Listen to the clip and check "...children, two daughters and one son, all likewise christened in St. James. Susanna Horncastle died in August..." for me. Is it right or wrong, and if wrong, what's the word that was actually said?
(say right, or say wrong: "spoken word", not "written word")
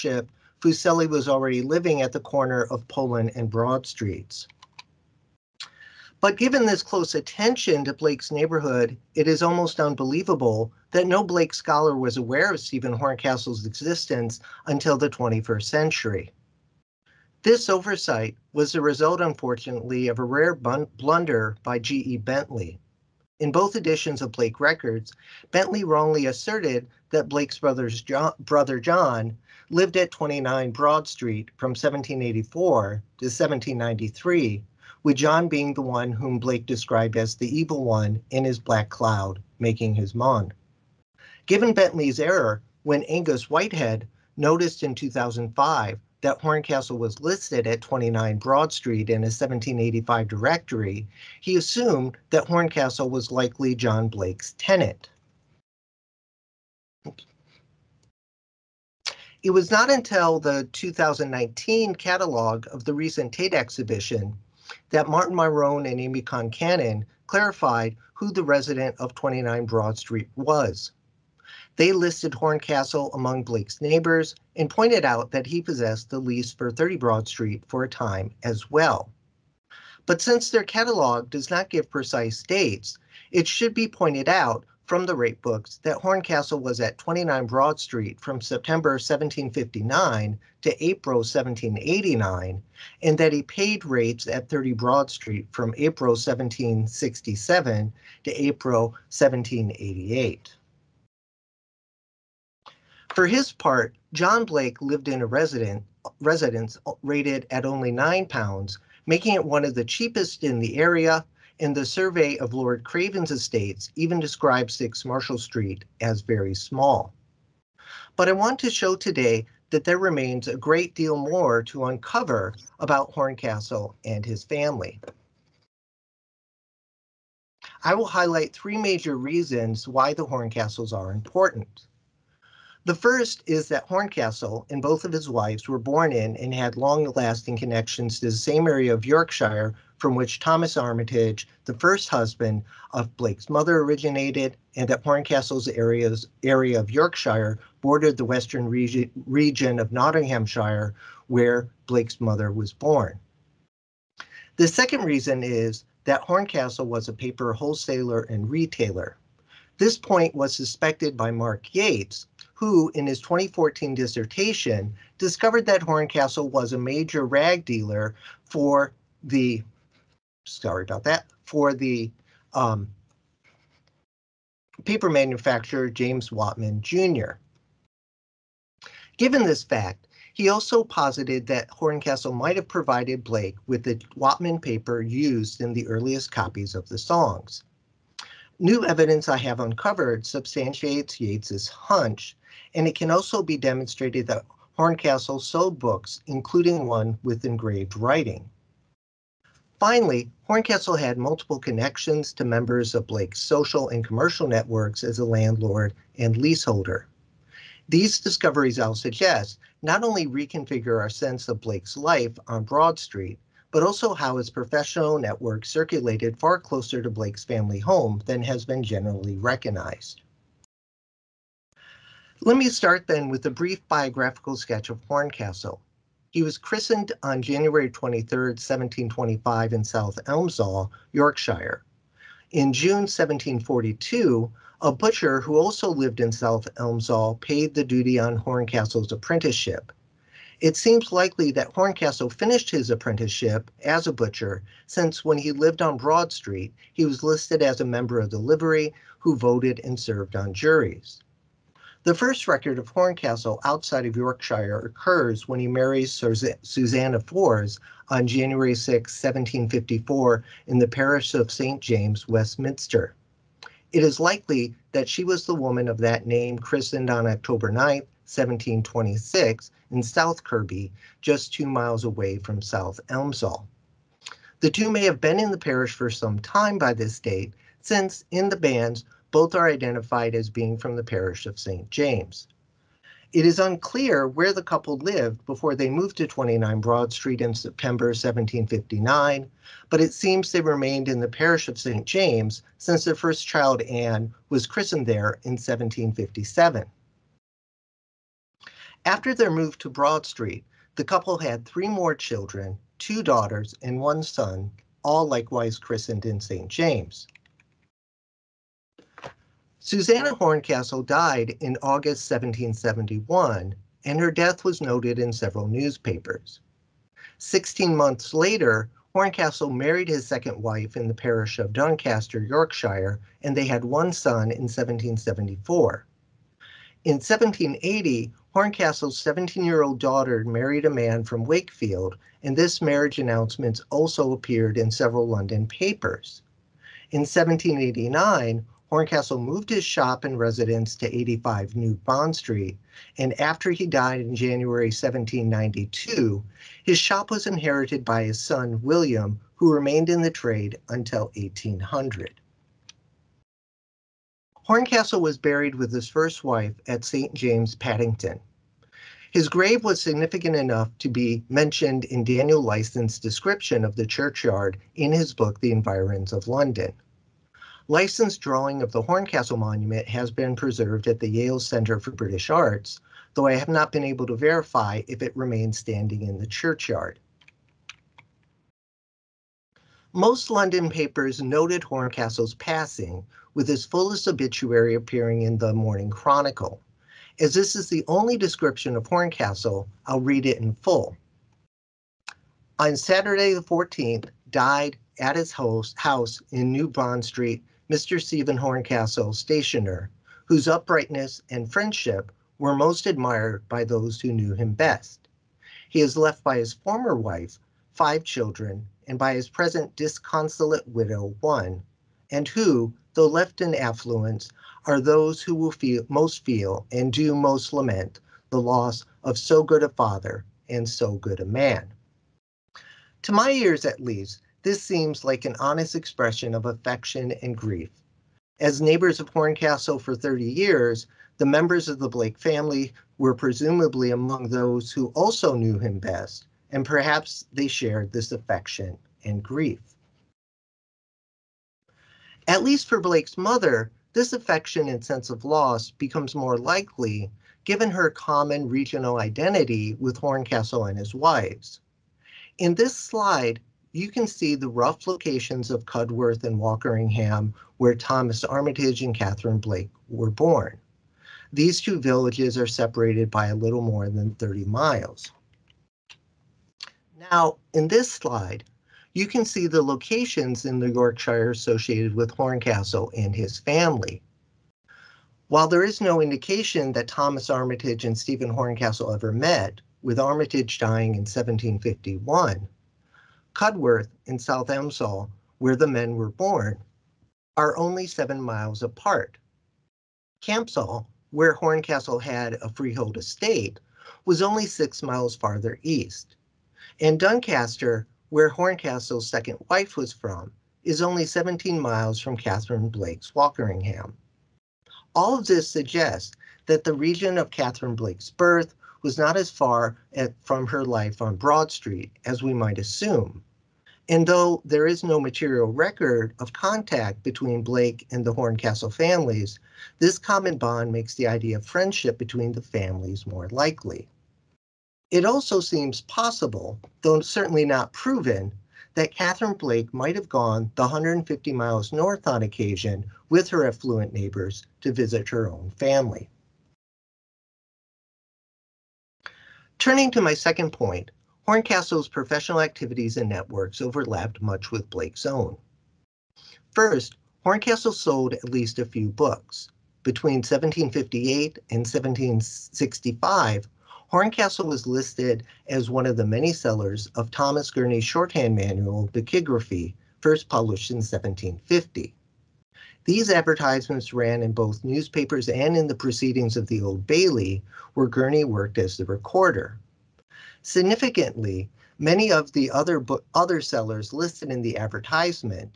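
right.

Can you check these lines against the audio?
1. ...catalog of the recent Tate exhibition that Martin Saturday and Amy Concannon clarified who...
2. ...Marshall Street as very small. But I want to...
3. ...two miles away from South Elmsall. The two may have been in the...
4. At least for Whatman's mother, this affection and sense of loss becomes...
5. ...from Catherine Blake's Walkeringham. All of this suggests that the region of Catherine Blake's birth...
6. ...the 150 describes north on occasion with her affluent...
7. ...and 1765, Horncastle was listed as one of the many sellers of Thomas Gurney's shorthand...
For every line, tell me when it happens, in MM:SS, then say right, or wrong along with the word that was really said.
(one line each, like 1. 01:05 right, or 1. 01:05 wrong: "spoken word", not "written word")
1. 01:01 wrong: "Myrone", not "Saturday"
2. 01:55 right
3. 04:31 right
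4. 07:22 wrong: "Blake", not "Whatman"
5. 08:22 right
6. 08:50 wrong: "miles", not "describes"
7. 09:11 right.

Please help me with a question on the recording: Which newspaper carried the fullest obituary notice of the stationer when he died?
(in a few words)
Morning Chronicle.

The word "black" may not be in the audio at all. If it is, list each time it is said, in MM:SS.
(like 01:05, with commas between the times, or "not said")
00:38.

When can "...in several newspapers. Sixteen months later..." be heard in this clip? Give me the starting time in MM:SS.
05:15.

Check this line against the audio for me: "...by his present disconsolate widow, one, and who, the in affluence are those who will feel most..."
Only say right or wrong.
right.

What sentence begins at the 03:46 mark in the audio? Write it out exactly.
He was christened on January 23, 1725 in South Elmsall, Yorkshire.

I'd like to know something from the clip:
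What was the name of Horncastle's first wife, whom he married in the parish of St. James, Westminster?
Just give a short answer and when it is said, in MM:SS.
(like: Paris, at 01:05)
Susanna Fors, at 04:16.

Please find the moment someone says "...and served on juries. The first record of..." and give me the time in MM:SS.
04:09.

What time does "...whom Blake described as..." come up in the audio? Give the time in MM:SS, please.
00:36.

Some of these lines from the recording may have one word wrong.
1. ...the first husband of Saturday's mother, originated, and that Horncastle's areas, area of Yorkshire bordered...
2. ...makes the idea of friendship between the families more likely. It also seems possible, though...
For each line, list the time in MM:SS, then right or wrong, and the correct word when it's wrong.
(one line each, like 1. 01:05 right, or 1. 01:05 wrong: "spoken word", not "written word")
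1. 02:21 wrong: "Blake", not "Saturday"
2. 08:40 right.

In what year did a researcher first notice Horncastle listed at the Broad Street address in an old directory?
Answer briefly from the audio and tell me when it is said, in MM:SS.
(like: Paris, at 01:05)
2005, at 00:44.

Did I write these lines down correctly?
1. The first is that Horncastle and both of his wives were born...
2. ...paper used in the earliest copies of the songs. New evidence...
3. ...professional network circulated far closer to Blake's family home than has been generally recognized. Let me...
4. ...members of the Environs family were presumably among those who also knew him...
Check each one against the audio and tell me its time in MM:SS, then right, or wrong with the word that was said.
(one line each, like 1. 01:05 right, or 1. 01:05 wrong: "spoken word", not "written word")
1. 02:12 right
2. 03:04 right
3. 03:34 right
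4. 07:11 wrong: "Blake", not "Environs".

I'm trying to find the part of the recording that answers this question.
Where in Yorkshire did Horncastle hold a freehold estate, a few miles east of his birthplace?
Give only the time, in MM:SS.
08:10.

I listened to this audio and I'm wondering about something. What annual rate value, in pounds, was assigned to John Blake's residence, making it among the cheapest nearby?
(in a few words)
9.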